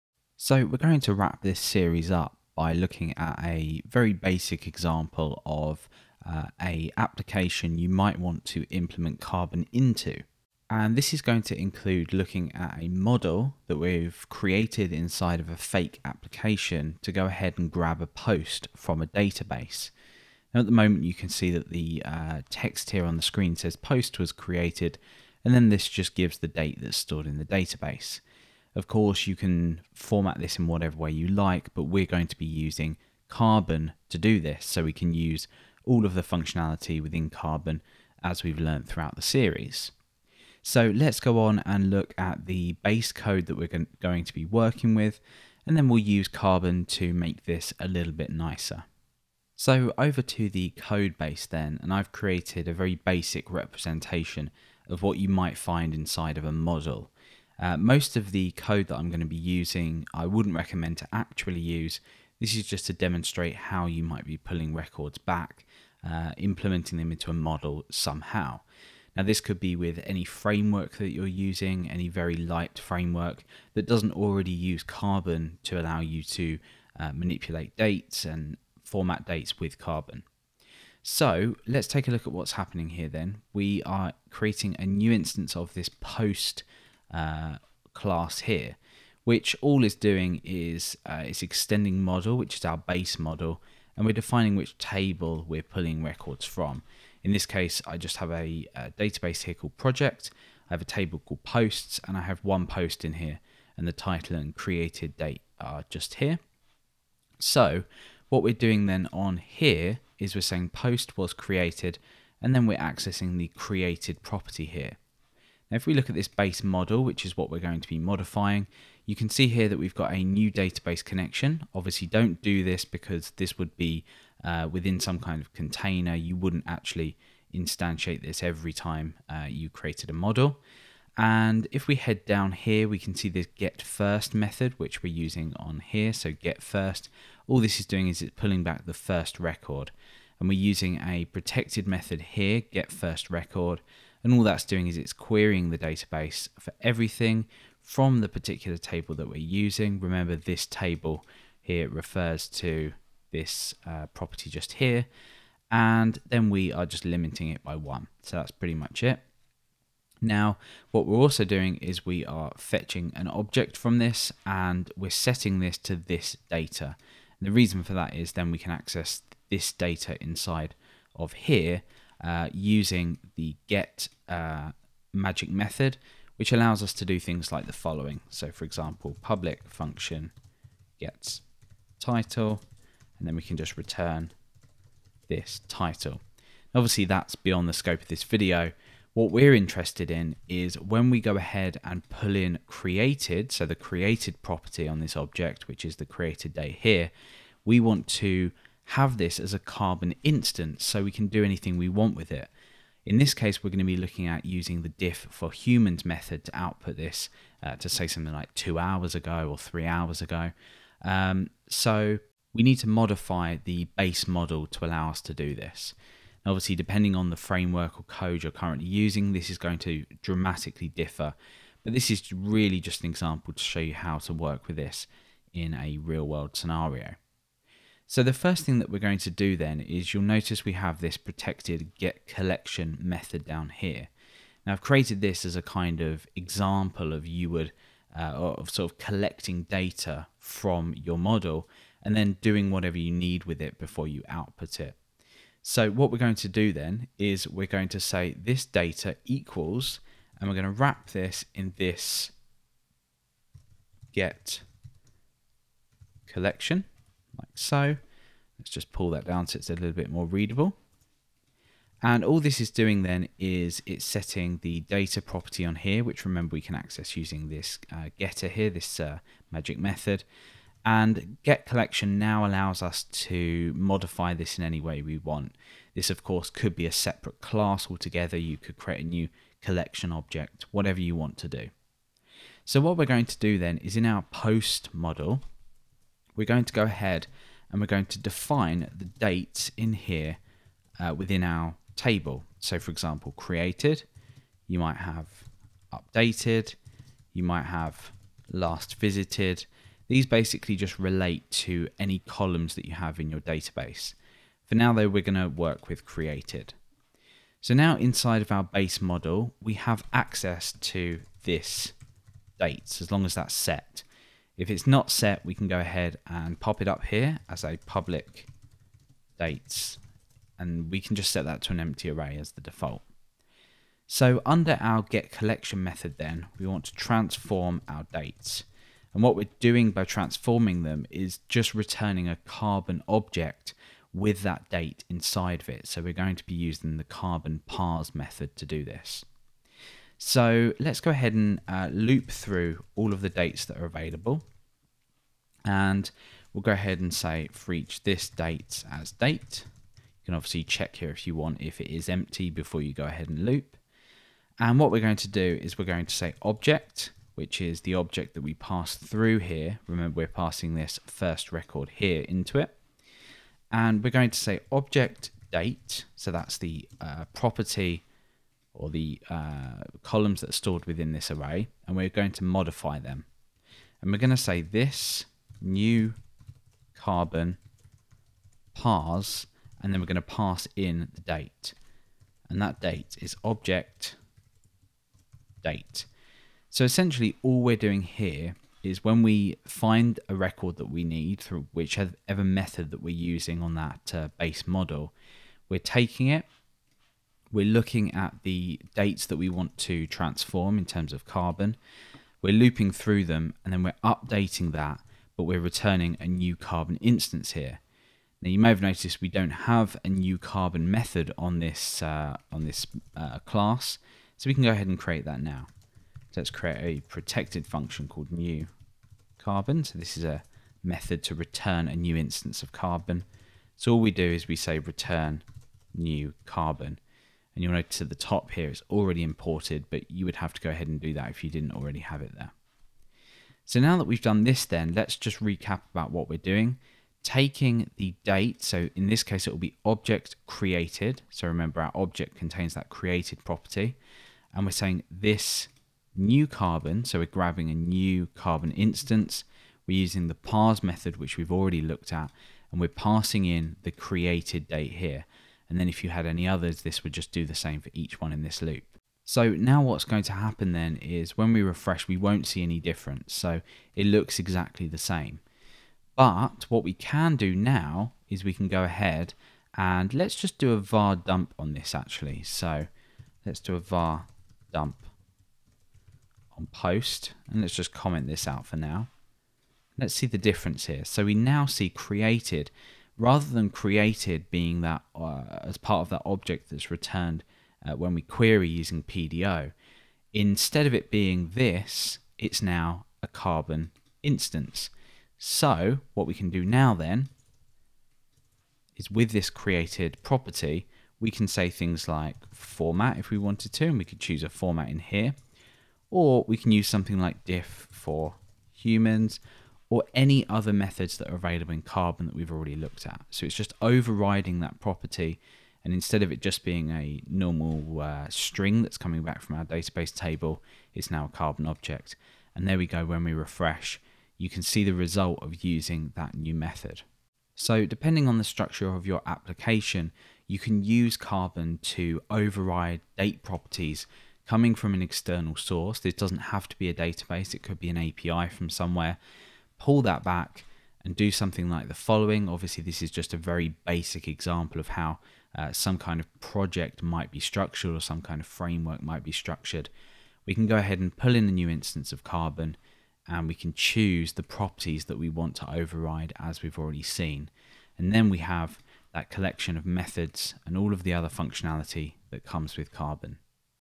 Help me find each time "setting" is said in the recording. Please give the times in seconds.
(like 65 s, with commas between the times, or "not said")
165 s, 264 s.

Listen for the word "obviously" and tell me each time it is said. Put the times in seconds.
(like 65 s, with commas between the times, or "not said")
121 s, 186 s, 216 s, 350 s, 542 s.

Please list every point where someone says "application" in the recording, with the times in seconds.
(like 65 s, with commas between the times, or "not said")
6 s, 16 s, 529 s.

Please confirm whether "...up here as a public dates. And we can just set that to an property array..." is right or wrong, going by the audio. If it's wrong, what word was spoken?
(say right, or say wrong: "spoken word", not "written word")
wrong: "empty", not "property".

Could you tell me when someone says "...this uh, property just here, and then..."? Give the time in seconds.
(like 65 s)
153 s.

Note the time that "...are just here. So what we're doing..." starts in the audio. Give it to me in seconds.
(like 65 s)
105 s.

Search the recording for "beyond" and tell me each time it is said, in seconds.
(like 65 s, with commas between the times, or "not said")
187 s.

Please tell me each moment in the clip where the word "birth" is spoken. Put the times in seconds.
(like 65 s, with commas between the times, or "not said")
not said.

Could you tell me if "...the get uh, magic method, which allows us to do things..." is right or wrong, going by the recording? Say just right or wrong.
right.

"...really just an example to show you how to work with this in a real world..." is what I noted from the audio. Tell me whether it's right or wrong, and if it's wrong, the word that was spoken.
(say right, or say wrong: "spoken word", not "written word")
right.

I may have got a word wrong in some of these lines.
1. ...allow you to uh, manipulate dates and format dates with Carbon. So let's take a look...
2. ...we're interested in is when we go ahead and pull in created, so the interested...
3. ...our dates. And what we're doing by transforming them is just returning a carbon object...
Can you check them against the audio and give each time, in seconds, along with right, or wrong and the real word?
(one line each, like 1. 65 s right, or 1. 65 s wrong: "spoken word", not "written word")
1. 75 s right
2. 189 s wrong: "created", not "interested"
3. 327 s right.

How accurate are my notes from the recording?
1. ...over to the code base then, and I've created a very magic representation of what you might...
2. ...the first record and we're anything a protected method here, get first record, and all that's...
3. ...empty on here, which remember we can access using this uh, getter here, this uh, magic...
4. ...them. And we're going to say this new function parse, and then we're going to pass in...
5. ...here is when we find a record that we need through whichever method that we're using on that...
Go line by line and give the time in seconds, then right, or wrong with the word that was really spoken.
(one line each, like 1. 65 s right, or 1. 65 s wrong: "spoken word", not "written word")
1. 49 s wrong: "basic", not "magic"
2. 138 s wrong: "using", not "anything"
3. 265 s wrong: "property", not "empty"
4. 372 s wrong: "carbon", not "function"
5. 388 s right.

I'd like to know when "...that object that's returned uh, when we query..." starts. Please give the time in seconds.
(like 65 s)
486 s.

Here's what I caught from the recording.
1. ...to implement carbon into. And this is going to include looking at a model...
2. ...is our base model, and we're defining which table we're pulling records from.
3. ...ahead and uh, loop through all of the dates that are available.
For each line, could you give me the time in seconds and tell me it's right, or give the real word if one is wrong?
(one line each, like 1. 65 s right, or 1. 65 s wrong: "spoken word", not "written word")
1. 8 s right
2. 92 s right
3. 341 s right.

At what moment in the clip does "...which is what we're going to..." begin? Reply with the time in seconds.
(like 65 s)
117 s.